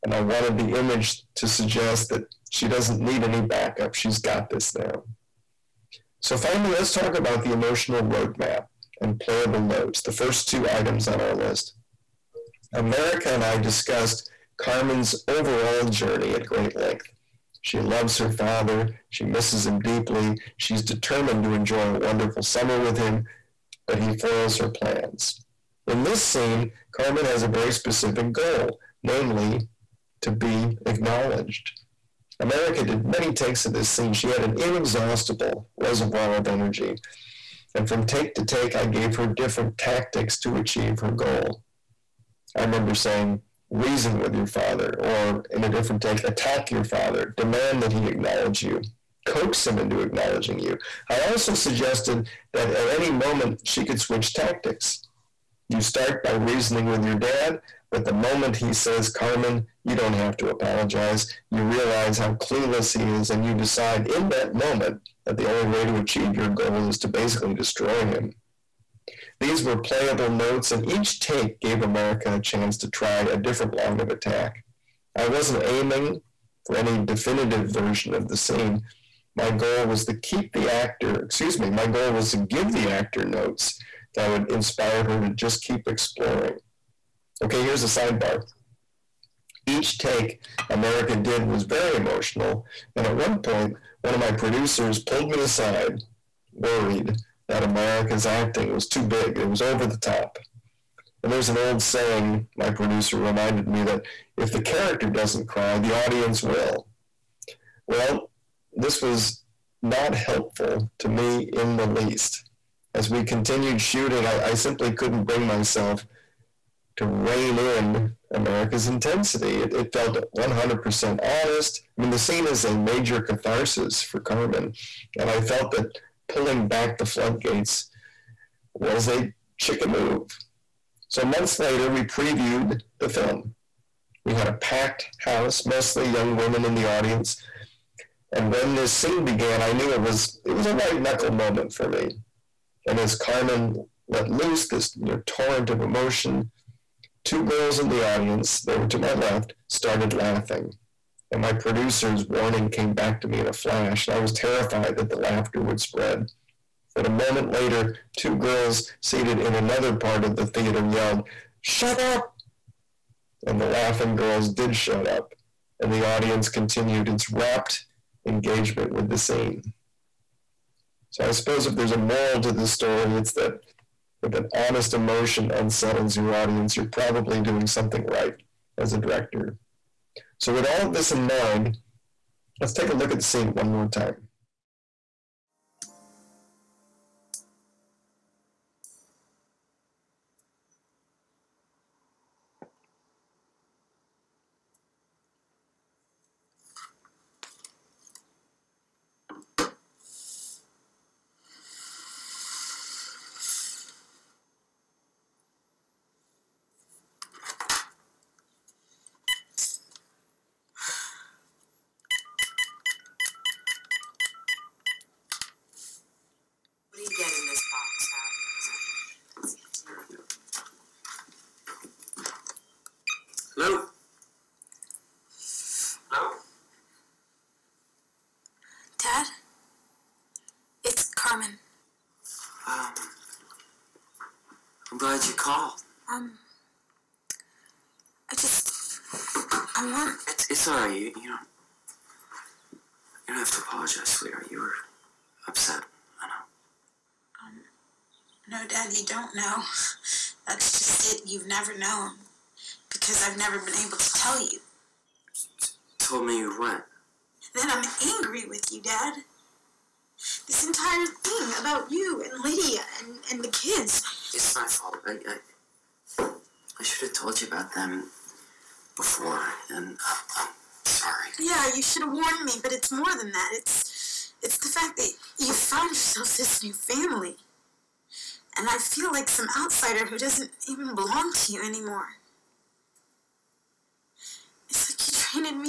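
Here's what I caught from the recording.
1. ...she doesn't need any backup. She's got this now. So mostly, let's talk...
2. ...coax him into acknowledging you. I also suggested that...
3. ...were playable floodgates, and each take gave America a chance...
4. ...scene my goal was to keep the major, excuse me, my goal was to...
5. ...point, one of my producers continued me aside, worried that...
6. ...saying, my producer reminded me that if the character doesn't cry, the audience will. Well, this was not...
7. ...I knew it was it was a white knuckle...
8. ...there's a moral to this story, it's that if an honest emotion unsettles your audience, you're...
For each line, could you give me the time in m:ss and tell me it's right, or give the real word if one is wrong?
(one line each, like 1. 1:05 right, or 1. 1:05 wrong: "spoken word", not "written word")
1. 0:02 wrong: "finally", not "mostly"
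2. 0:49 right
3. 1:09 wrong: "notes", not "floodgates"
4. 1:18 wrong: "actor", not "major"
5. 1:33 wrong: "pulled", not "continued"
6. 1:41 right
7. 2:19 right
8. 2:51 right.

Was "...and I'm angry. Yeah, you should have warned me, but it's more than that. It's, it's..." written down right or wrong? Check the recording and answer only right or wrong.
wrong.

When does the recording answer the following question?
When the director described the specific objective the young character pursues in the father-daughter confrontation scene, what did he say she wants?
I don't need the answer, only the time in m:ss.
0:30.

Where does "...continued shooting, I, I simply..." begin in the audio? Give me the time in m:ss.
1:53.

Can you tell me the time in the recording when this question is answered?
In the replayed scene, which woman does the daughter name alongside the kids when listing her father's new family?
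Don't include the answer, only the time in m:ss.
4:22.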